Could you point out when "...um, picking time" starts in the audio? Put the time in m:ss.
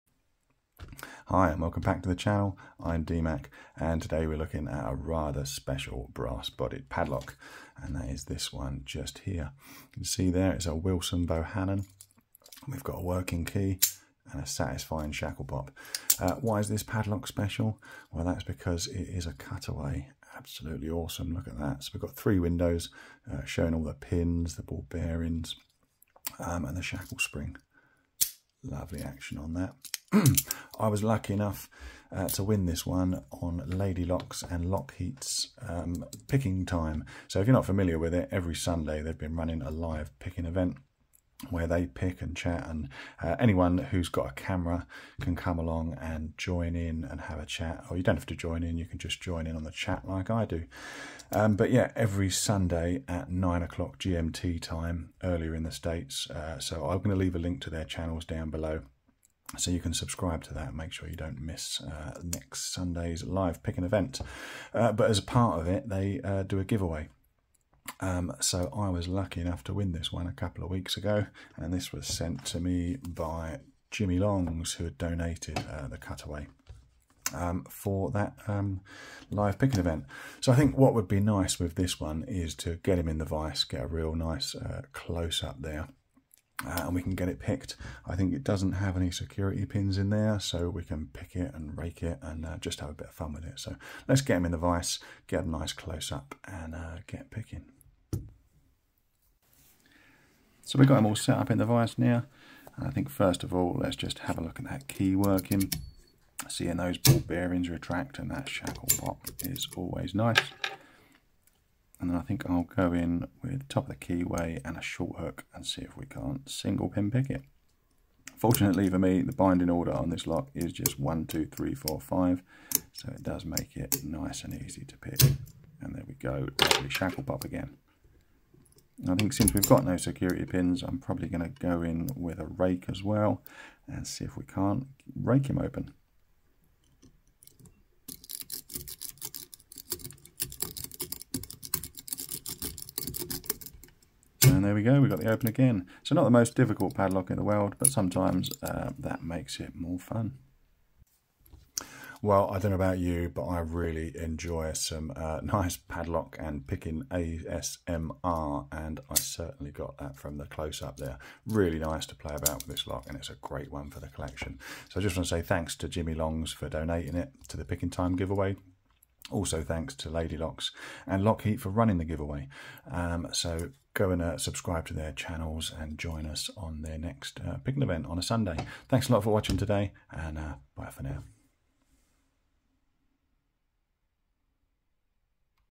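0:35.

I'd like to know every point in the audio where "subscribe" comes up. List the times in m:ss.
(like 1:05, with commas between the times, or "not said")
0:59, 2:54.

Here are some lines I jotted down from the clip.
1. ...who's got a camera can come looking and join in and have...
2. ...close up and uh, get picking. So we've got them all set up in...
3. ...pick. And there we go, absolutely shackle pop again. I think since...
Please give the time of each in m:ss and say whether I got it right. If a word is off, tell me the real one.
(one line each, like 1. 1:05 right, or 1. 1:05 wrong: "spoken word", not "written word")
1. 0:43 wrong: "along", not "looking"
2. 1:35 right
3. 2:04 wrong: "lovely", not "absolutely".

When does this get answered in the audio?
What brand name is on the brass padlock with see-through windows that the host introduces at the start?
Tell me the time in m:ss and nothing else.
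0:10.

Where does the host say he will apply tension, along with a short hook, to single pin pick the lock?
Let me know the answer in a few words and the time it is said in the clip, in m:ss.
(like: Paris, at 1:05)
top of the keyway, at 1:53.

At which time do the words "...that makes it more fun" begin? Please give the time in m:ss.
2:28.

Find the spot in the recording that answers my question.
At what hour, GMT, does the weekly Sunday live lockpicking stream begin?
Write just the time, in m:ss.
0:53.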